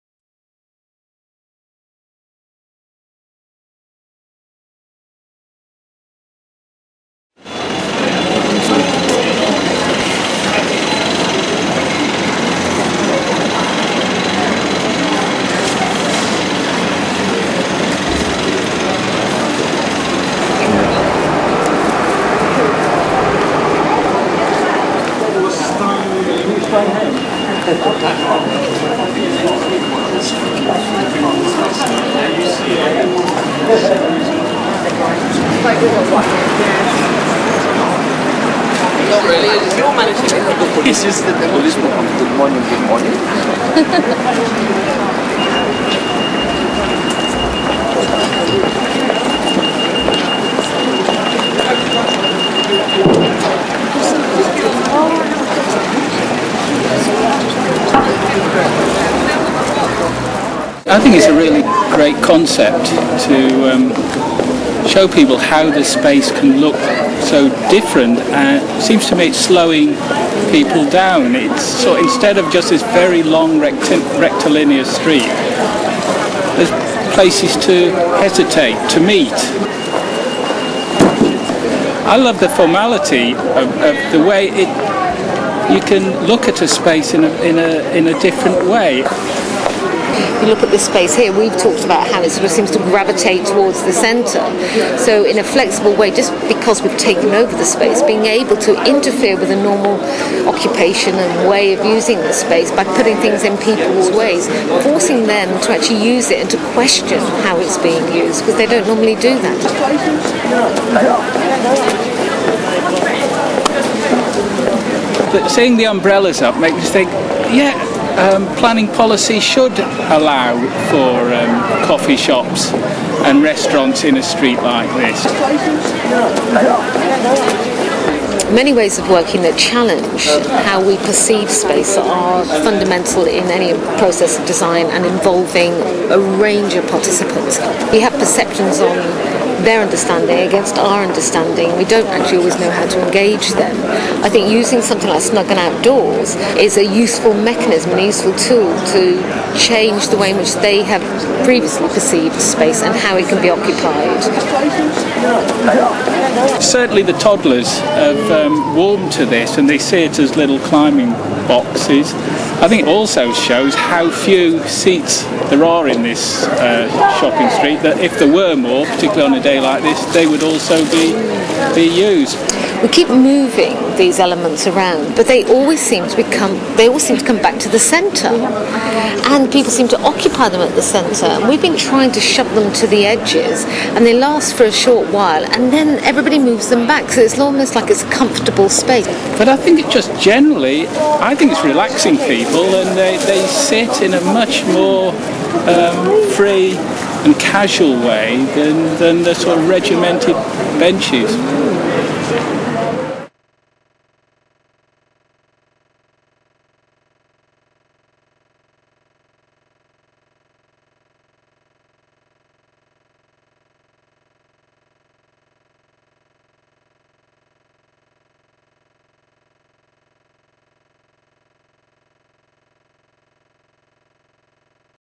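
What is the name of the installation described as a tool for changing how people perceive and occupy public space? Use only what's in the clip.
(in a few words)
Snug and Outdoors.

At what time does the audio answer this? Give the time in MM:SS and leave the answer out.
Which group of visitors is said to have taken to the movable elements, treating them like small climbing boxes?
02:37.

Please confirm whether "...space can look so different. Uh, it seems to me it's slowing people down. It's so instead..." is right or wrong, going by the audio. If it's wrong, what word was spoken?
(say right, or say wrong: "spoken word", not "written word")
right.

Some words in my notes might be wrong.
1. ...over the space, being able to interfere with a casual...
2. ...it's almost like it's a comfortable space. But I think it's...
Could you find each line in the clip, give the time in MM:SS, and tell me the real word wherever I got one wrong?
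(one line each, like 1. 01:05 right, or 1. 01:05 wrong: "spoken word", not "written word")
1. 01:37 wrong: "normal", not "casual"
2. 03:07 right.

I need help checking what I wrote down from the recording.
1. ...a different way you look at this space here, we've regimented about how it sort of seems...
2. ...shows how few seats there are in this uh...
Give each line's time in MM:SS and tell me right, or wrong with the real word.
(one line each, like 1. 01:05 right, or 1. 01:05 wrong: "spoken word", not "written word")
1. 01:28 wrong: "talked", not "regimented"
2. 02:43 right.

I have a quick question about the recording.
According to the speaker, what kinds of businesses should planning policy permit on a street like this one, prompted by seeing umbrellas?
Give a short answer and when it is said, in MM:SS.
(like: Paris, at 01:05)
coffee shops and restaurants, at 02:01.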